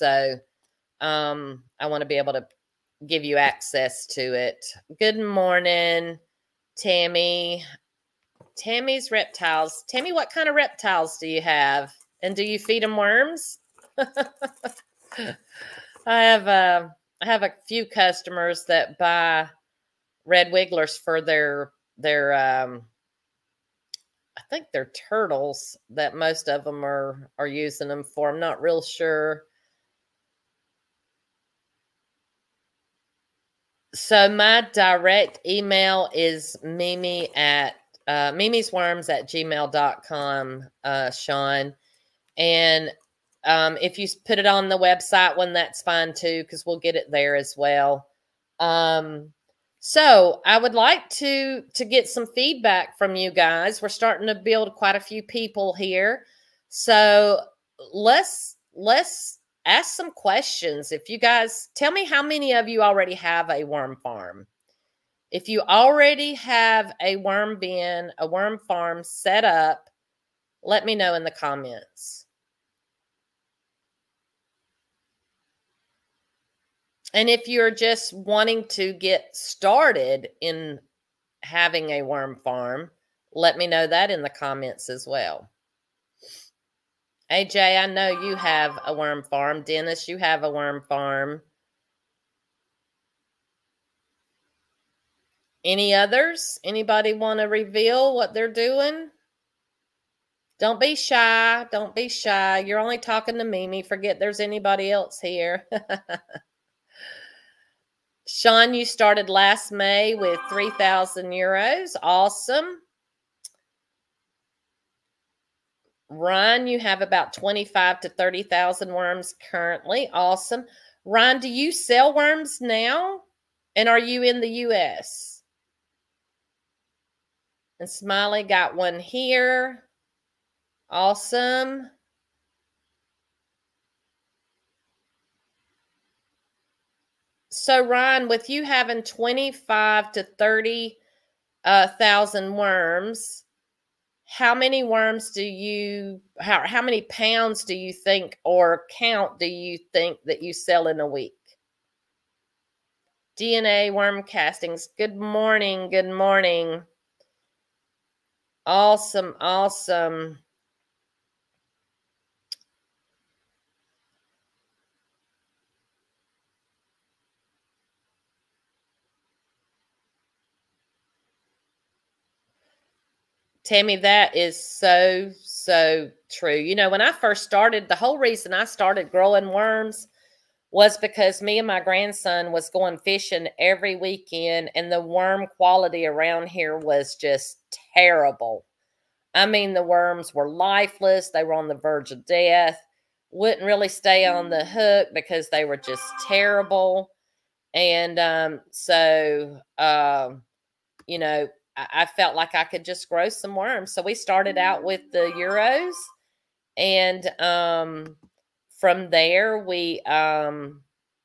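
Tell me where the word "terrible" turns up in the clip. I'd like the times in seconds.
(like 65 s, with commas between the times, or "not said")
187 s, 196 s.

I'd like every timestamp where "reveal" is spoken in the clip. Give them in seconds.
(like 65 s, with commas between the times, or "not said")
97 s.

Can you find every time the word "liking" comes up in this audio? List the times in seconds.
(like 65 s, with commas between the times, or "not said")
not said.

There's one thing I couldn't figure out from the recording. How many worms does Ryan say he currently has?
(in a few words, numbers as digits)
25,000 to 30,000.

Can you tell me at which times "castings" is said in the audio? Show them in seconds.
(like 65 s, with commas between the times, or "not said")
154 s.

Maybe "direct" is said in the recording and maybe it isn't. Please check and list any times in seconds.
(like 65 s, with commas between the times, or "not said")
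34 s.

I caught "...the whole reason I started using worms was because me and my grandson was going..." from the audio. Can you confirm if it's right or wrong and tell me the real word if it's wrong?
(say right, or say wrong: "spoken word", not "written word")
wrong: "growing", not "using".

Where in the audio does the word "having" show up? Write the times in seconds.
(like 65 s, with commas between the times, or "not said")
81 s, 138 s.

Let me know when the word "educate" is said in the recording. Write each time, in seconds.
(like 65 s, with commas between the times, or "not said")
not said.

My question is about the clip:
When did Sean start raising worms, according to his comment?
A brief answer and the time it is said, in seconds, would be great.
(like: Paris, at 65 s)
Last May, at 109 s.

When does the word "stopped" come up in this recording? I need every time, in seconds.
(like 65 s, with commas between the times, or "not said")
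not said.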